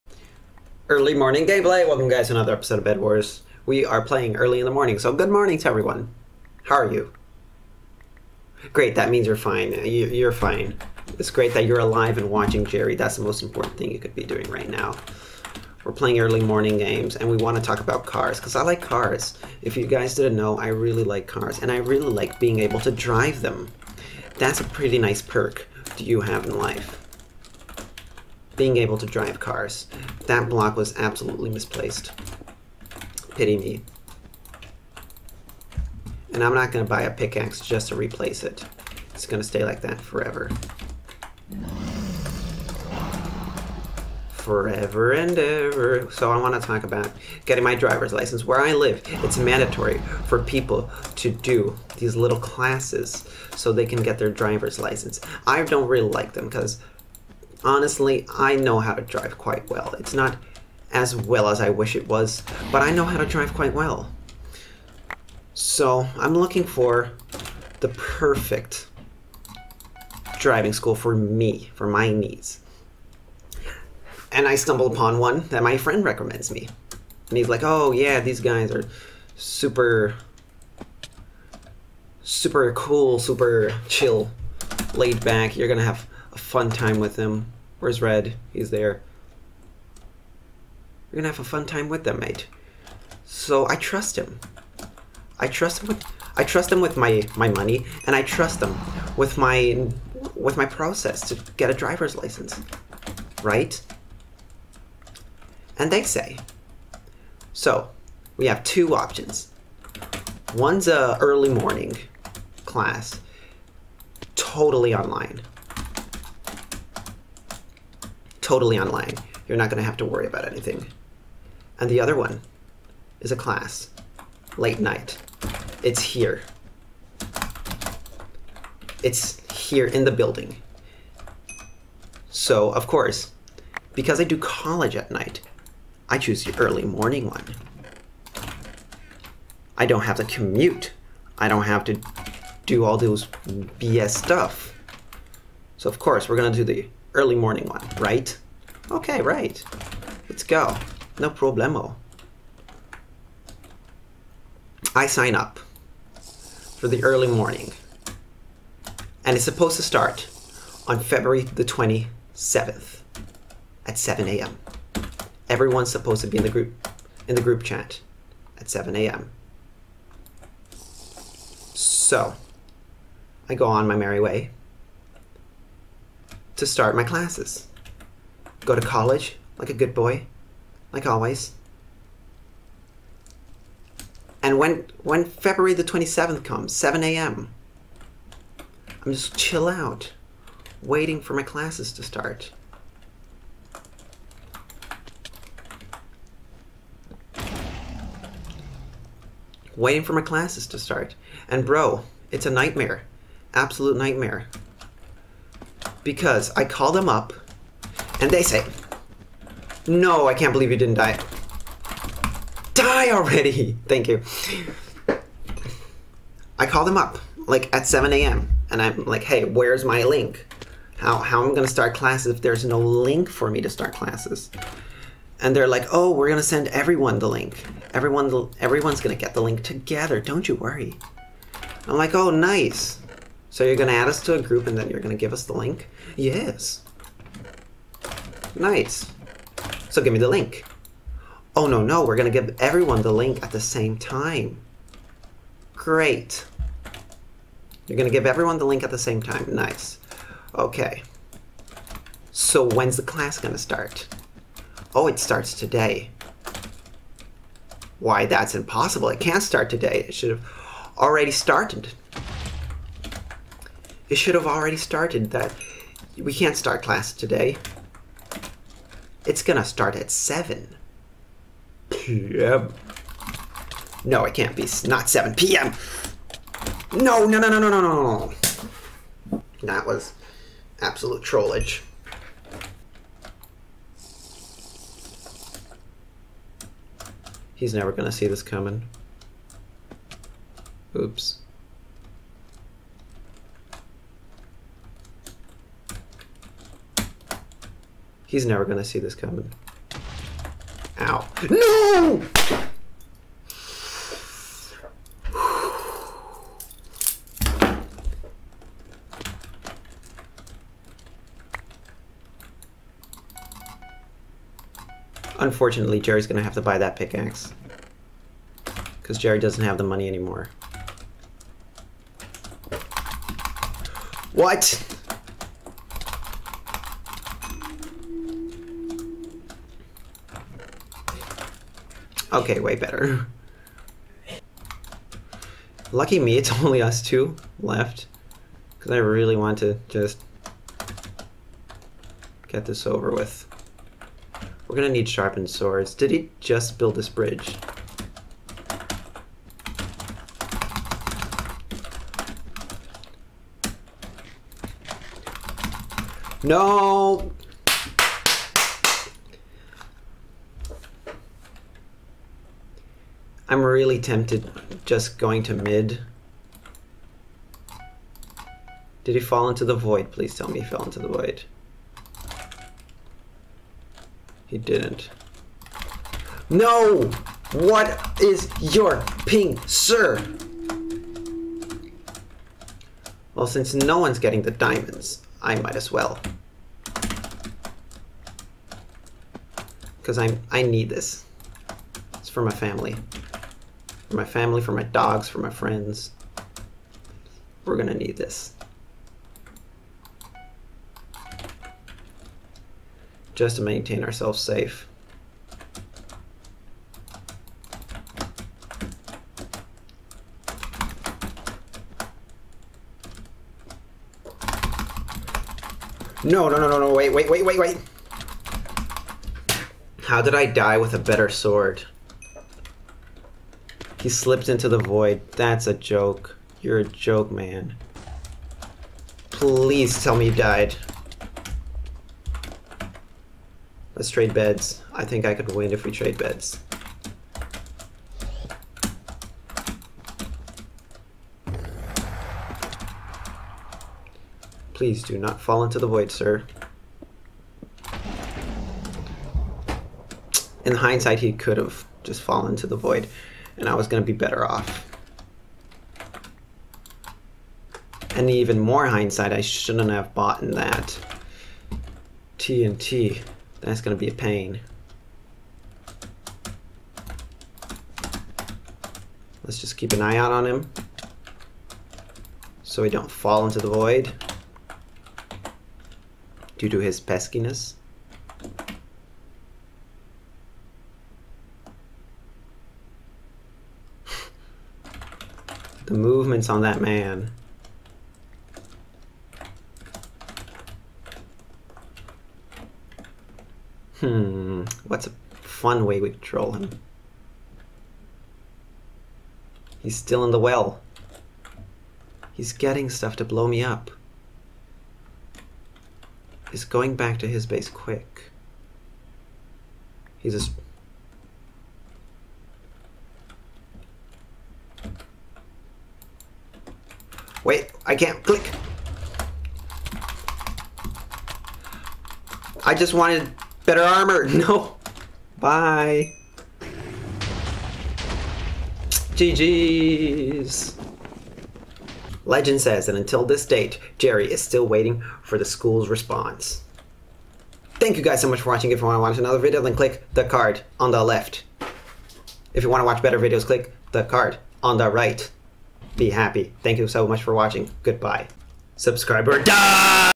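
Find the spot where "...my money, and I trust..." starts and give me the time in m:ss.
1:37.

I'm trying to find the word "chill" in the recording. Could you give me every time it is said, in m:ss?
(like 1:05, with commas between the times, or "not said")
1:23, 3:09.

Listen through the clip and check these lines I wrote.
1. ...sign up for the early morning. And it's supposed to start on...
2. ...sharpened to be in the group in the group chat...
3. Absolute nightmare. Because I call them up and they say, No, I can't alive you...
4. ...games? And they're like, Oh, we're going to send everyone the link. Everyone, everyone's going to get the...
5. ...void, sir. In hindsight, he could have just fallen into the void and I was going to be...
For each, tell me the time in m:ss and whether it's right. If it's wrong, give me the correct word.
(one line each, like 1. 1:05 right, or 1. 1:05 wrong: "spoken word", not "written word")
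1. 2:35 right
2. 2:45 wrong: "supposed", not "sharpened"
3. 3:23 wrong: "believe", not "alive"
4. 3:43 wrong: "classes", not "games"
5. 7:25 right.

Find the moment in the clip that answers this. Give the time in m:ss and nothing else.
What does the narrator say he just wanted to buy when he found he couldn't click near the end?
8:43.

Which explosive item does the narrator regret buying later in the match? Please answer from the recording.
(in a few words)
TNT.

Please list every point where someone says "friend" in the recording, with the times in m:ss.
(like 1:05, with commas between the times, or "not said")
1:15, 6:35.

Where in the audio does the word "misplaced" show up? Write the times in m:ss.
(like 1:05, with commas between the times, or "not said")
0:31.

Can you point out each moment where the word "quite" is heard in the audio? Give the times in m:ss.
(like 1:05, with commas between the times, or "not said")
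0:59, 1:03.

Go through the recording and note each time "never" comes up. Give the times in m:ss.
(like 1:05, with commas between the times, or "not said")
4:47, 4:58.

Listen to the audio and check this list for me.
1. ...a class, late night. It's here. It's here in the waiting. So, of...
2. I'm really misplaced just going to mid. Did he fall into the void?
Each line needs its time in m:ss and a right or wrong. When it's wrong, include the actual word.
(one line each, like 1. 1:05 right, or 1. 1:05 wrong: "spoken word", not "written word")
1. 2:03 wrong: "building", not "waiting"
2. 6:03 wrong: "tempted", not "misplaced".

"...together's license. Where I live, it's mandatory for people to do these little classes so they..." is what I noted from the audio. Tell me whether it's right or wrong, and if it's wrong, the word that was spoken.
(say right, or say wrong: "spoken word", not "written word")
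wrong: "driver", not "together".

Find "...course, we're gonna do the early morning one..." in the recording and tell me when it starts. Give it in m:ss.
2:25.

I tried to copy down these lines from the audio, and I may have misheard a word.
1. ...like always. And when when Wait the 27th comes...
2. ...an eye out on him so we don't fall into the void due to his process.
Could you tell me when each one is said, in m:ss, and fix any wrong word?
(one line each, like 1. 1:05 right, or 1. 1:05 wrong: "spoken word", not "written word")
1. 3:00 wrong: "February", not "Wait"
2. 7:49 wrong: "peskiness", not "process".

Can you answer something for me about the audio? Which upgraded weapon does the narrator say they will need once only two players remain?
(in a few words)
Sharpened swords.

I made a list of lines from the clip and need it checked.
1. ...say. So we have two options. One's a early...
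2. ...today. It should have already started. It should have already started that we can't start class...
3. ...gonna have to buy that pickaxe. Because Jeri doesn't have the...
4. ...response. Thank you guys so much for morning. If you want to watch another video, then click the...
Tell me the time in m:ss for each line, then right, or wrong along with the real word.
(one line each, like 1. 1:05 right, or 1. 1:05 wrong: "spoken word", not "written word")
1. 1:46 right
2. 4:19 right
3. 5:16 right
4. 8:55 wrong: "watching", not "morning".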